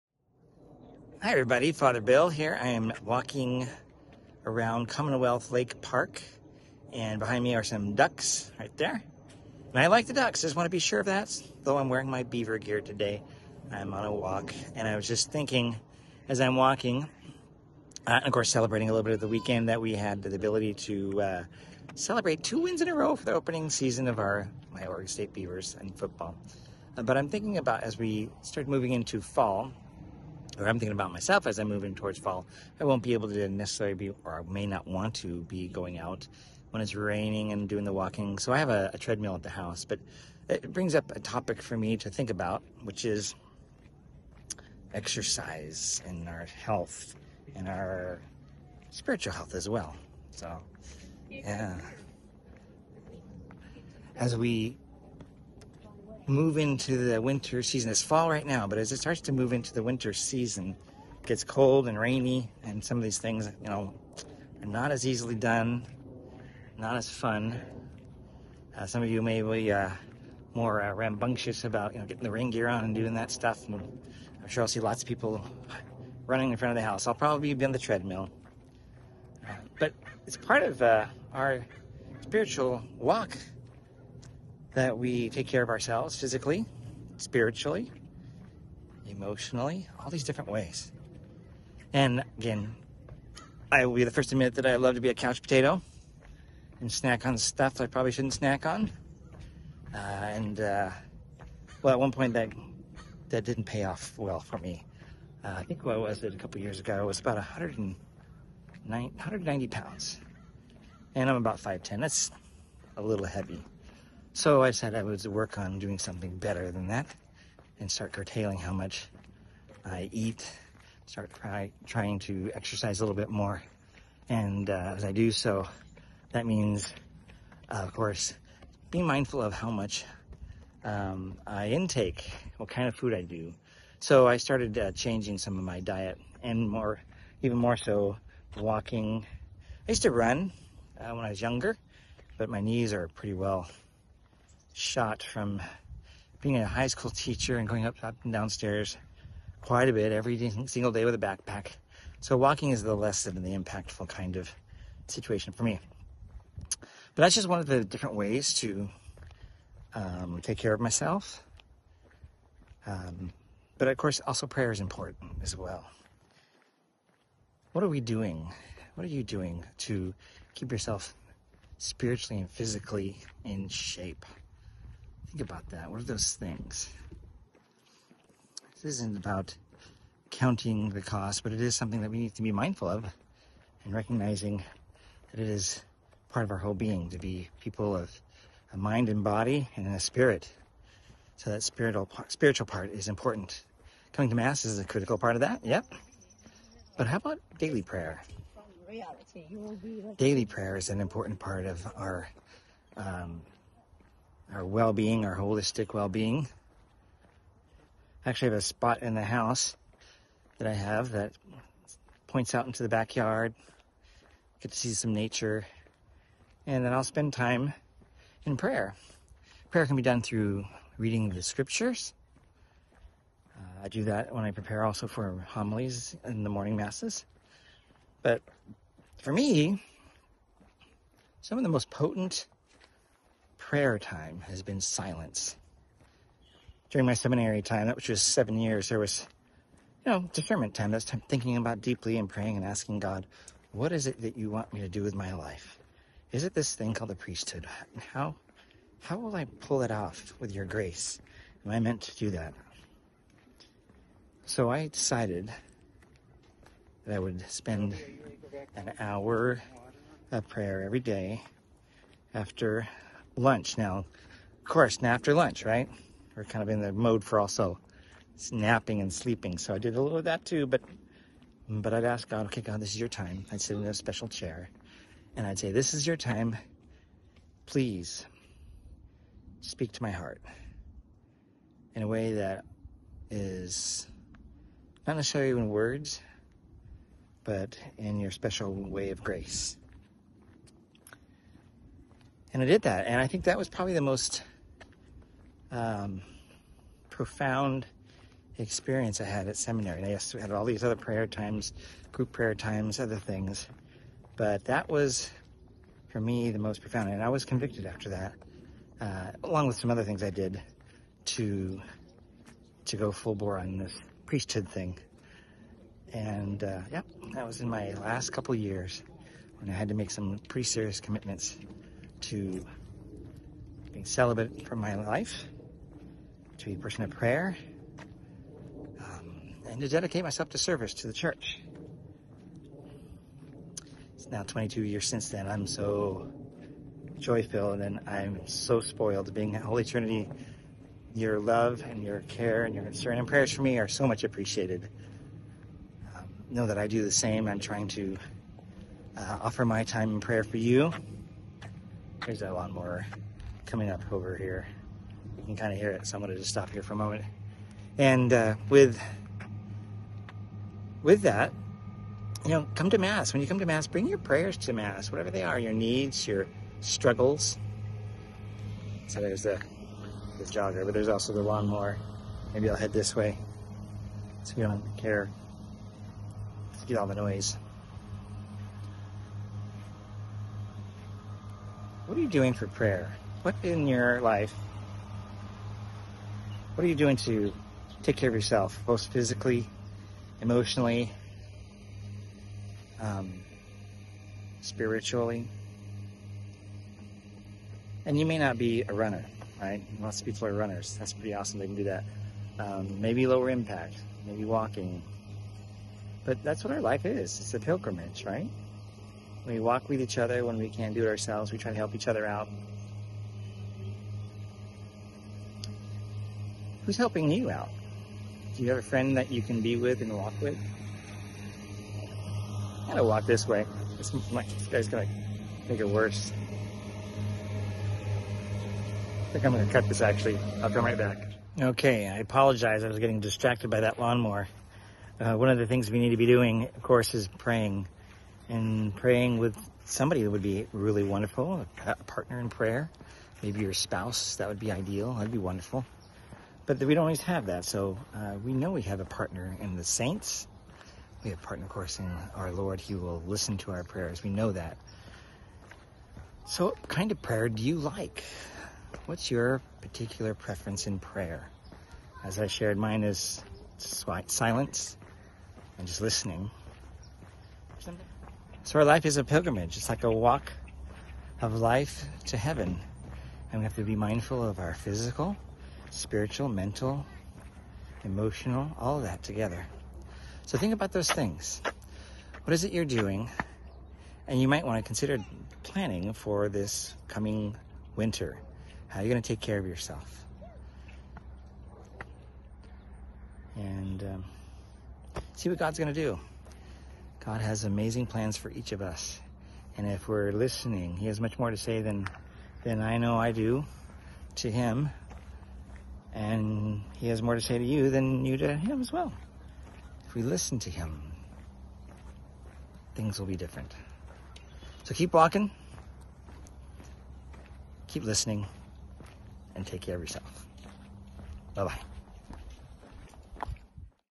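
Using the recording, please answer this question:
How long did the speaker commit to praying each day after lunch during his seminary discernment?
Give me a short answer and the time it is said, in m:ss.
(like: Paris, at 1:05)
an hour, at 4:18.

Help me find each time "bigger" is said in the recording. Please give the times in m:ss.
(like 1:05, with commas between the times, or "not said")
not said.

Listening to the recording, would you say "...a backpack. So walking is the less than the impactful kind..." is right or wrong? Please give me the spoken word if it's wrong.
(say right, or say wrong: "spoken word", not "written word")
right.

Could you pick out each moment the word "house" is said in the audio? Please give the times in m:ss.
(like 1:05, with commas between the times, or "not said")
0:39, 1:16, 3:29.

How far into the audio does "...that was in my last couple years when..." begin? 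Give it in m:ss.
5:17.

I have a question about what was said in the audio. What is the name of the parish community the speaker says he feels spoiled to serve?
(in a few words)
Holy Trinity.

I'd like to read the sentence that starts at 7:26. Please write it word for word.
But we don't always have that, so uh, we know we have a partner in the saints.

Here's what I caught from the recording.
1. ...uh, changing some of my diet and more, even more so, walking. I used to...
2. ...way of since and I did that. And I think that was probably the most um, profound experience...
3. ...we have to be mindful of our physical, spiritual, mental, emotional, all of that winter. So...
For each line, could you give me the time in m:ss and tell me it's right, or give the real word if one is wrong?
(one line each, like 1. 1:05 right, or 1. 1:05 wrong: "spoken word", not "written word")
1. 2:14 right
2. 4:48 wrong: "grace", not "since"
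3. 7:53 wrong: "together", not "winter".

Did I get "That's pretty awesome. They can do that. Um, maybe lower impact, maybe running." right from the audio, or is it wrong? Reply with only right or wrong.
wrong.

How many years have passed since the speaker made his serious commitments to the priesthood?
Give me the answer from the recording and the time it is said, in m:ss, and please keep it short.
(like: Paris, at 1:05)
22, at 5:34.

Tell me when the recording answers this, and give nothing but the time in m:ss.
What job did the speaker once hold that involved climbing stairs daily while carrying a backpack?
2:26.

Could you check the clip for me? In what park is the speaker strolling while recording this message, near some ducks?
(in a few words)
Commonwealth Lake Park.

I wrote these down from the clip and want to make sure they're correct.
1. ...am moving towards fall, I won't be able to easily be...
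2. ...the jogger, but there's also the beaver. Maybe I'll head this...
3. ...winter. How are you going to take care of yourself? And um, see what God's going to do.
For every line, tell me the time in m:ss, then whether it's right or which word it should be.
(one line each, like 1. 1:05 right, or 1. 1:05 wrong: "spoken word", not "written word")
1. 0:31 wrong: "necessarily", not "easily"
2. 6:10 wrong: "lawnmower", not "beaver"
3. 8:07 right.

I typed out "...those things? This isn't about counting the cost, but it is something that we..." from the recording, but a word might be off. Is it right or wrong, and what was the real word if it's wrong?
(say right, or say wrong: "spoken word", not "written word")
right.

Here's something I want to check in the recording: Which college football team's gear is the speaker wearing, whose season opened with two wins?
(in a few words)
Oregon State Beavers.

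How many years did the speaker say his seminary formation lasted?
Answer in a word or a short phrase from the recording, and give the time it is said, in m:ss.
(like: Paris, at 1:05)
7, at 3:58.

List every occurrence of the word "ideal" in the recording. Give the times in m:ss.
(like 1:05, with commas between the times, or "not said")
7:24.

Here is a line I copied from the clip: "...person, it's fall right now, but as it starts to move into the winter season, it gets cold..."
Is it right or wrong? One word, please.
wrong.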